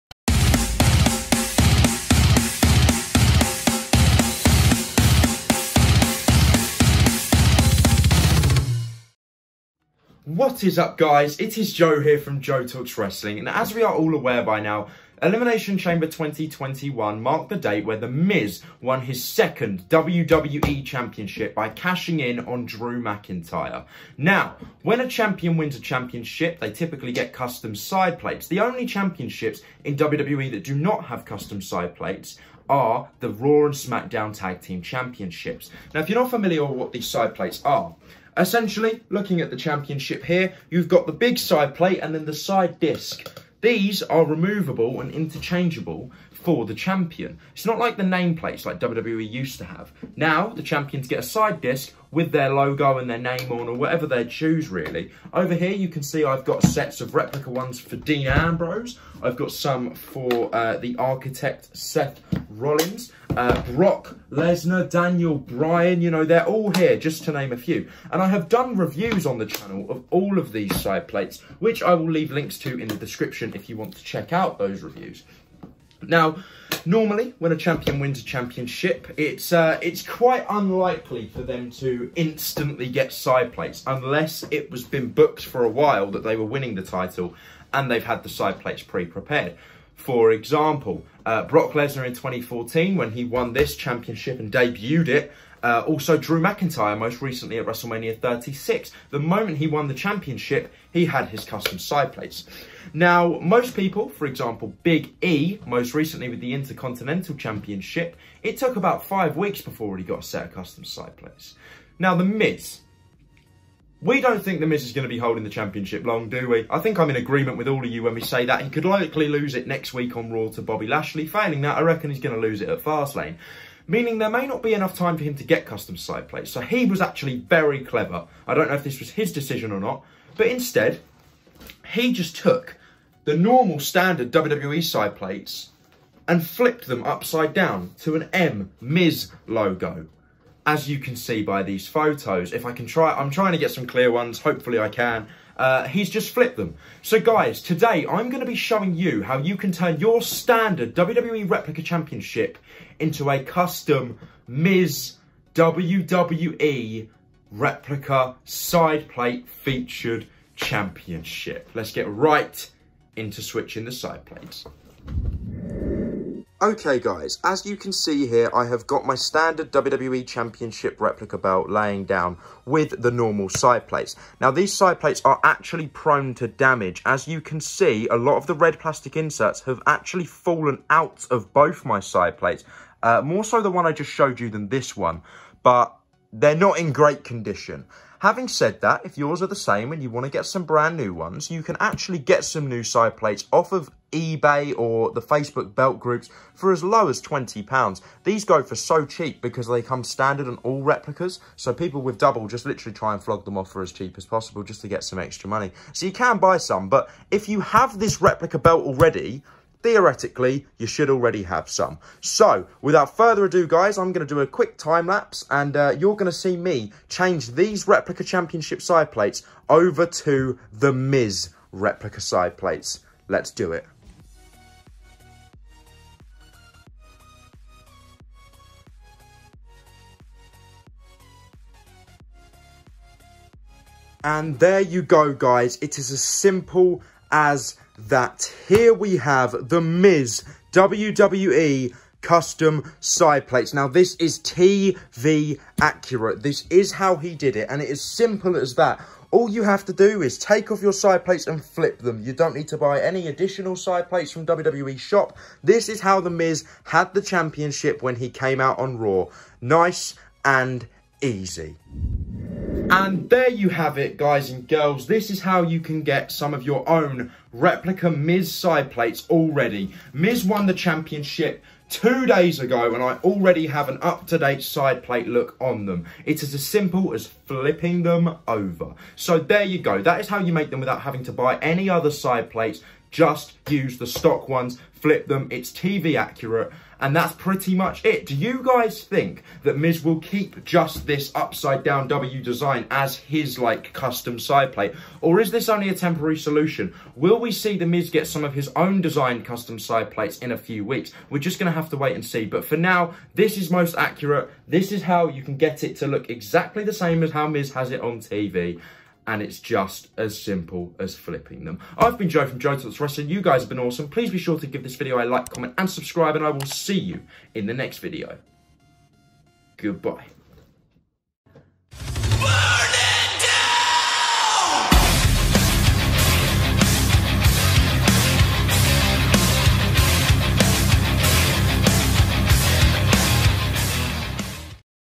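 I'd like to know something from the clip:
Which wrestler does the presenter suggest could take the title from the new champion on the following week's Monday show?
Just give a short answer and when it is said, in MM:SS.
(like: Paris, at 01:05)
Bobby Lashley, at 02:00.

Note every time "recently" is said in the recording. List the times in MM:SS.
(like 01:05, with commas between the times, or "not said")
01:37, 01:45.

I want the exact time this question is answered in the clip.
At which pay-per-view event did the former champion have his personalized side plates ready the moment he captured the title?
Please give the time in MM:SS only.
01:37.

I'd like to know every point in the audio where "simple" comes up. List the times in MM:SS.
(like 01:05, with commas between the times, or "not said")
03:56, 04:08, 04:36, 05:10.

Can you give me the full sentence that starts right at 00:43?
These are removable and interchangeable for the champion.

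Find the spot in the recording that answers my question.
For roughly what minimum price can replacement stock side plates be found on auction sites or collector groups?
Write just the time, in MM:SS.
03:17.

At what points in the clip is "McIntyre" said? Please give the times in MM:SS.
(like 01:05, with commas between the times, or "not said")
00:23, 01:36.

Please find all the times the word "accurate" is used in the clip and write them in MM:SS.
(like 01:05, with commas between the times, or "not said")
04:05, 04:46, 05:03.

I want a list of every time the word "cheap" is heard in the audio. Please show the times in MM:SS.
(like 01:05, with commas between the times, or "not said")
03:19, 03:23.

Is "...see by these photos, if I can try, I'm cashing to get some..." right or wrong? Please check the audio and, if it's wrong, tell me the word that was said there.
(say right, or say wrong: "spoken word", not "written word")
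wrong: "trying", not "cashing".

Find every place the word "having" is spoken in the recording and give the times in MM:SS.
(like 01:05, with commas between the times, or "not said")
03:08, 04:41.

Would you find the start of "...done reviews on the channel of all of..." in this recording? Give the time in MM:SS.
01:08.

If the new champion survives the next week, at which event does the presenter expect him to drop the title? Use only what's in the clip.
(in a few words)
Fastlane.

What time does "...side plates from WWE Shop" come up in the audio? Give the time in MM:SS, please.
04:13.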